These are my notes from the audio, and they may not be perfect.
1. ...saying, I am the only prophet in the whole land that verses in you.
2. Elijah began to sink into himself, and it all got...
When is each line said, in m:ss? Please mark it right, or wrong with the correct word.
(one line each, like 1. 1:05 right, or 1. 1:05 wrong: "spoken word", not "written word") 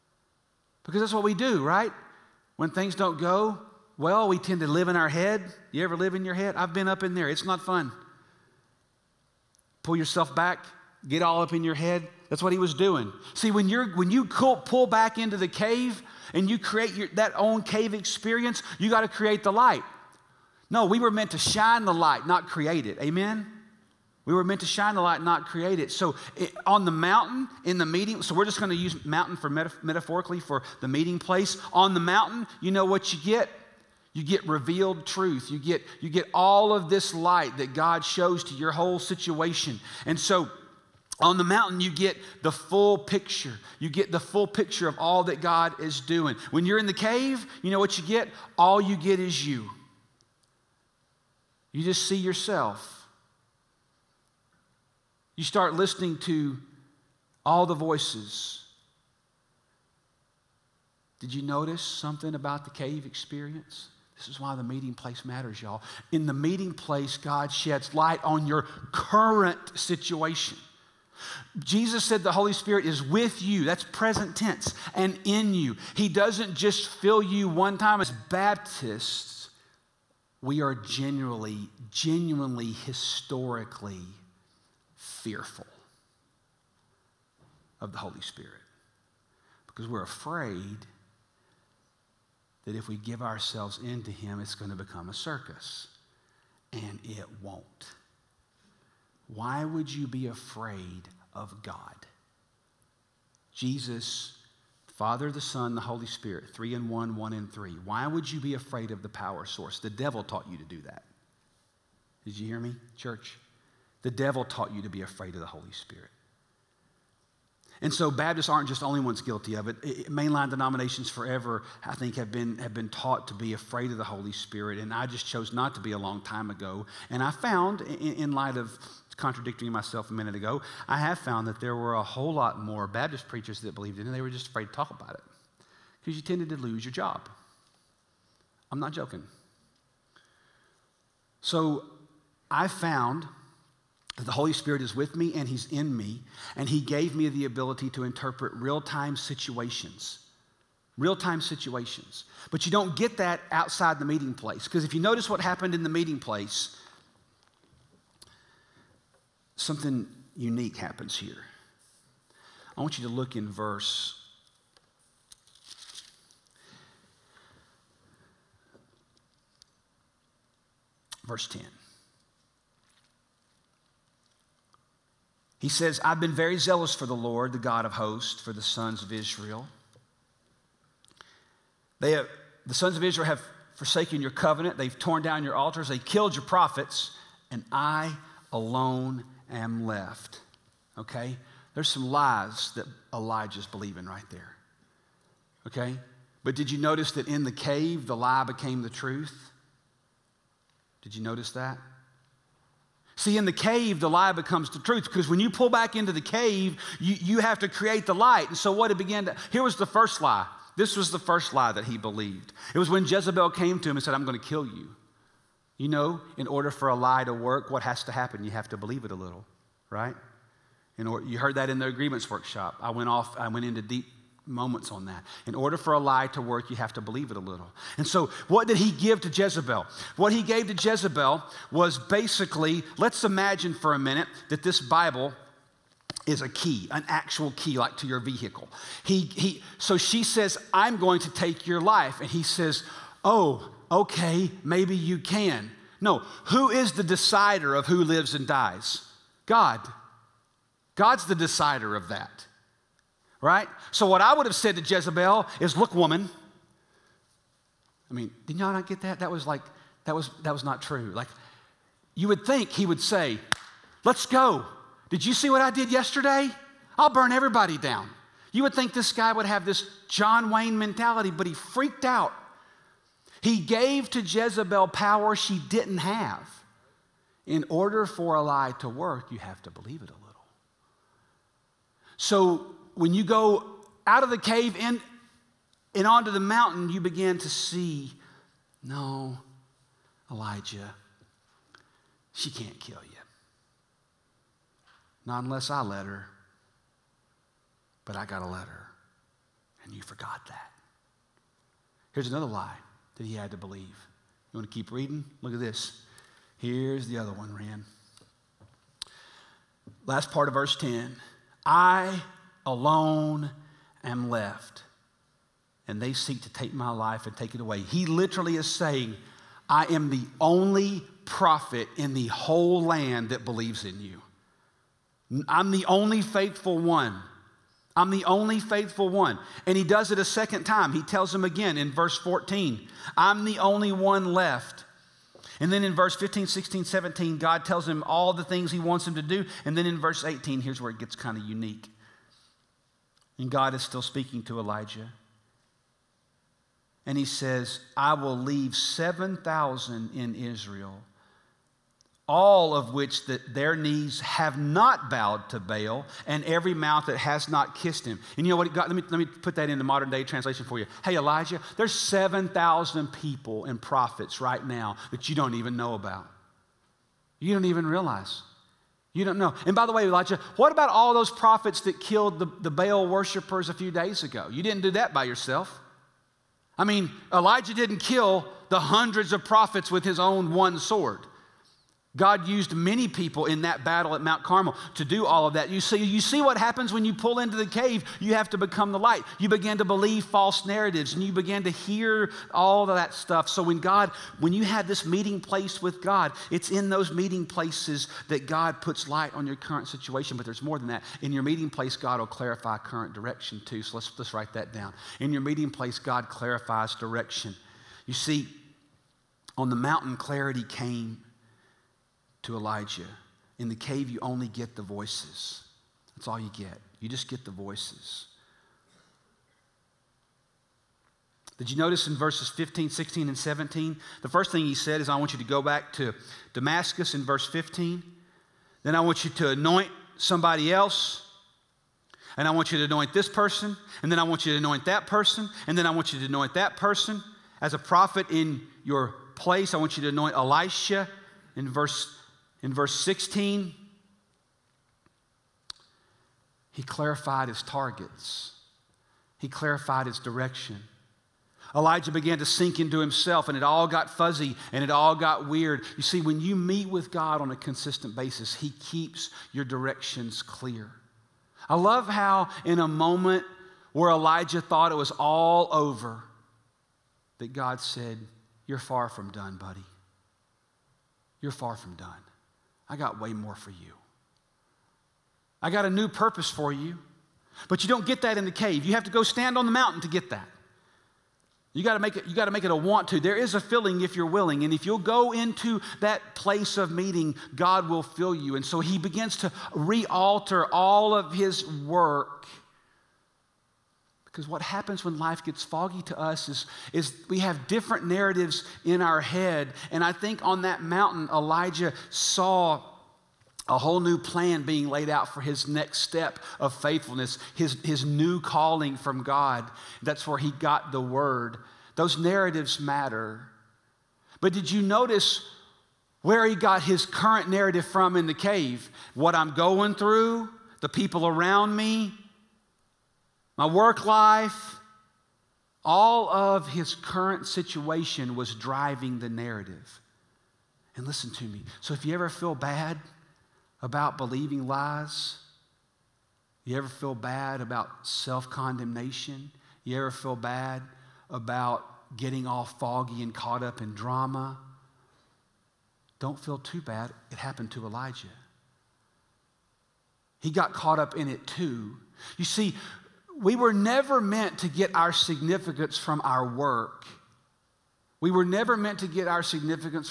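1. 5:18 wrong: "believes", not "verses"
2. 7:31 right.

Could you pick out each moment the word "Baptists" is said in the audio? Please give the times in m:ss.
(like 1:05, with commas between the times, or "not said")
1:18, 1:58, 2:12.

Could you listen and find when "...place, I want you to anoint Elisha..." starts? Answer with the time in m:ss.
7:19.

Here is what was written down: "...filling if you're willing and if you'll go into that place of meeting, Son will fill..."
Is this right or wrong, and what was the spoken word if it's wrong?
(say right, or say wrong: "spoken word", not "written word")
wrong: "God", not "Son".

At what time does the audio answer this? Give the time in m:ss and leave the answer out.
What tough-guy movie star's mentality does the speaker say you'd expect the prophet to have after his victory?
4:30.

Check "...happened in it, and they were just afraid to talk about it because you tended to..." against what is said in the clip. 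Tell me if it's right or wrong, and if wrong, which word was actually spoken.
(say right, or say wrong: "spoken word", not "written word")
wrong: "believed", not "happened".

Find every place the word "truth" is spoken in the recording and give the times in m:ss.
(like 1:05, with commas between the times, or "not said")
0:35, 3:18, 3:24.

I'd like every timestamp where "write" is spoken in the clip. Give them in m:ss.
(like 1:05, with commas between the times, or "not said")
6:44.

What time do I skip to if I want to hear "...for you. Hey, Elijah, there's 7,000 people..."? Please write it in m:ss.
6:00.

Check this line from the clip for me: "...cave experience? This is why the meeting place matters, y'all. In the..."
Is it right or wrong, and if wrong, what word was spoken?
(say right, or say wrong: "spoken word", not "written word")
right.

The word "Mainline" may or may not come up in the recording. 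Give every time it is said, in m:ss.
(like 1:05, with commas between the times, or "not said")
2:00.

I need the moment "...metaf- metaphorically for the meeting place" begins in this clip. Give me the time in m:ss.
0:29.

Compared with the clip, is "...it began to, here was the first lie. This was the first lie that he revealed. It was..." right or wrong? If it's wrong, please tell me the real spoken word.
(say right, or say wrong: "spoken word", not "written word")
wrong: "believed", not "revealed".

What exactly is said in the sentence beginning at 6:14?
You didn't do that by yourself.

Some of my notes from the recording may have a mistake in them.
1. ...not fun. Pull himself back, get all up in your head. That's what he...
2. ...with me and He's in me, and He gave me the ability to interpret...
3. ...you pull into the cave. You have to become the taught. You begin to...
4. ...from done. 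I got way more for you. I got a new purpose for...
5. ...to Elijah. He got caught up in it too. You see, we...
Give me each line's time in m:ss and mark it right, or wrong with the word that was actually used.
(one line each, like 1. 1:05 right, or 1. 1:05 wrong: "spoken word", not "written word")
1. 0:07 wrong: "yourself", not "himself"
2. 2:24 right
3. 6:27 wrong: "light", not "taught"
4. 7:51 right
5. 9:07 right.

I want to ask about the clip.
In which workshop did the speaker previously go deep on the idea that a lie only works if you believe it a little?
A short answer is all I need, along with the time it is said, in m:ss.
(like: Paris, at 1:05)
agreements workshop, at 3:41.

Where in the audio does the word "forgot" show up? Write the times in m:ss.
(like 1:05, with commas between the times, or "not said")
5:00.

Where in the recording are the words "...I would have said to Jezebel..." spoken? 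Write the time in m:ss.
4:14.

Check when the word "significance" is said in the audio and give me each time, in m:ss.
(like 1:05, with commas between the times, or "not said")
9:15, 9:19.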